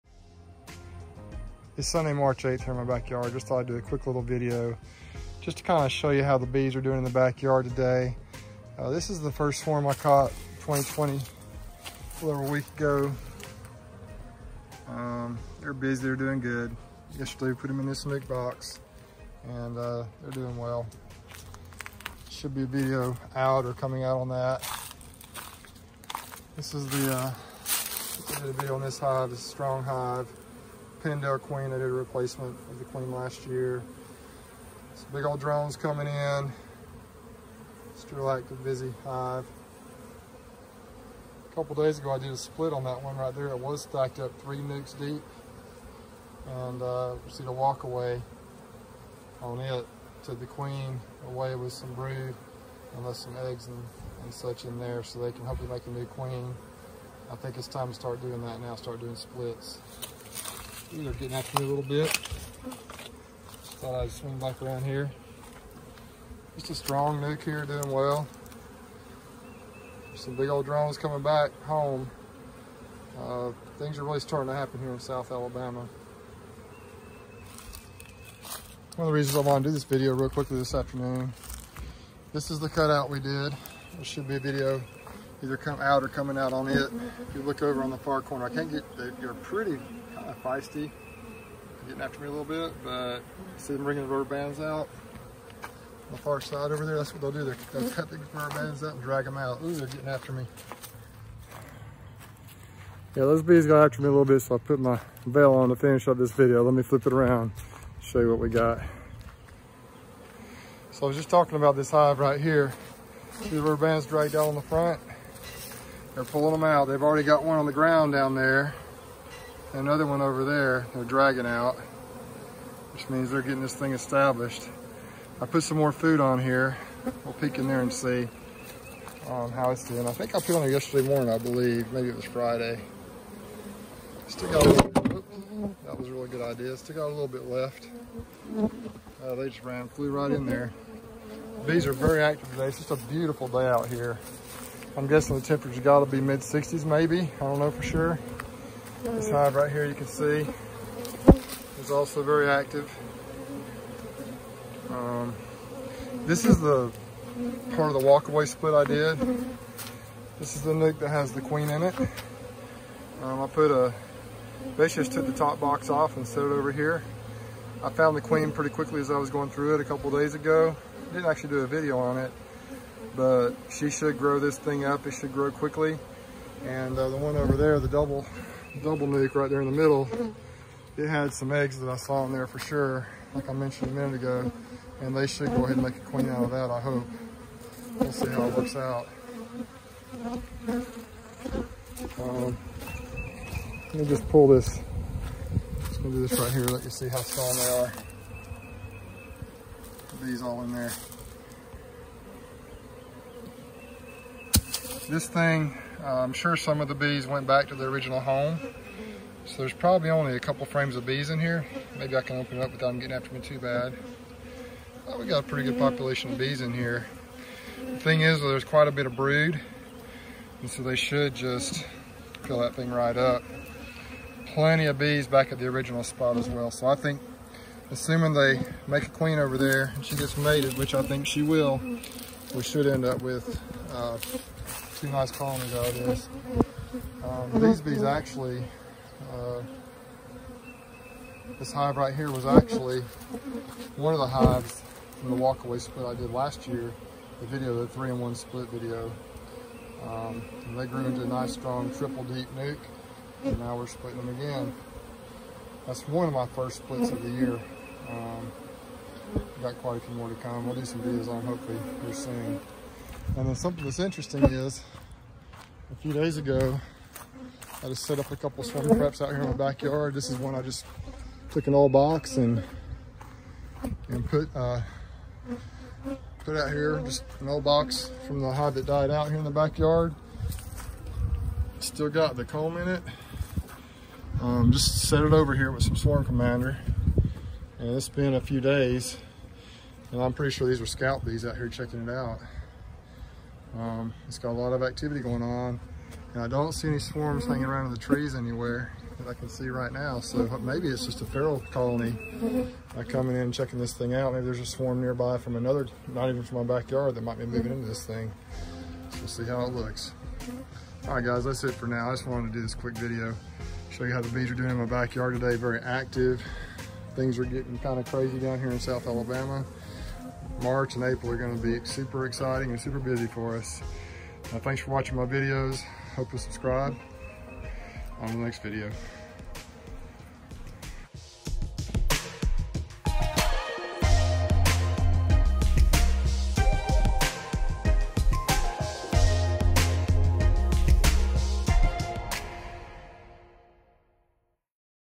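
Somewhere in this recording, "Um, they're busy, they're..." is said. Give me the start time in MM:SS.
00:14.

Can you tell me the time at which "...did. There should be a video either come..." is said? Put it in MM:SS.
01:23.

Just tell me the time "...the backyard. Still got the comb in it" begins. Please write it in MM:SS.
04:39.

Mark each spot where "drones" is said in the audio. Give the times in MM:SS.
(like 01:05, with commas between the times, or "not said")
00:35, 01:10.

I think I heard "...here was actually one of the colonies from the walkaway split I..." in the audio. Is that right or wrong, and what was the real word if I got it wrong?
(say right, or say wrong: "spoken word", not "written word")
wrong: "hives", not "colonies".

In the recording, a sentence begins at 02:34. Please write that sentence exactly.
Um, this is the part of the walkaway split I did.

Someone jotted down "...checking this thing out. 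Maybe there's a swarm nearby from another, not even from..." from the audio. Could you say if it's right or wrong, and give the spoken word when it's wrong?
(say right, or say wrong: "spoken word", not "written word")
right.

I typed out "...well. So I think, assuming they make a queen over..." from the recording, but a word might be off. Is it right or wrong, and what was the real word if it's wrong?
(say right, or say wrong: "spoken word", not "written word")
right.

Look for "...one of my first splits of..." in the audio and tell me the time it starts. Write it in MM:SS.
04:16.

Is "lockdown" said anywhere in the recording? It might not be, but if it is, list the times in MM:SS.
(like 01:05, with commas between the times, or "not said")
not said.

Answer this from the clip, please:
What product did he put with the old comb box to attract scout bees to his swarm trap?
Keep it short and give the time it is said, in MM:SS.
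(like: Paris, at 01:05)
swarm commander, at 04:45.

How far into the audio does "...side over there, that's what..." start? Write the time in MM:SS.
01:36.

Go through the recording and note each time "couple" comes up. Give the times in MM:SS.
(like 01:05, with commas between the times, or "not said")
00:41, 02:49, 03:30, 04:28.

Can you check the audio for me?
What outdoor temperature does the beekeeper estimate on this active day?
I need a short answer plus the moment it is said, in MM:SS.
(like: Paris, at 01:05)
mid 60s, at 02:26.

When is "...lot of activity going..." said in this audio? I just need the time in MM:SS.
04:54.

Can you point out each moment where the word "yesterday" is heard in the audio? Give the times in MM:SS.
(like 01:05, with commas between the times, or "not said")
00:17, 02:10.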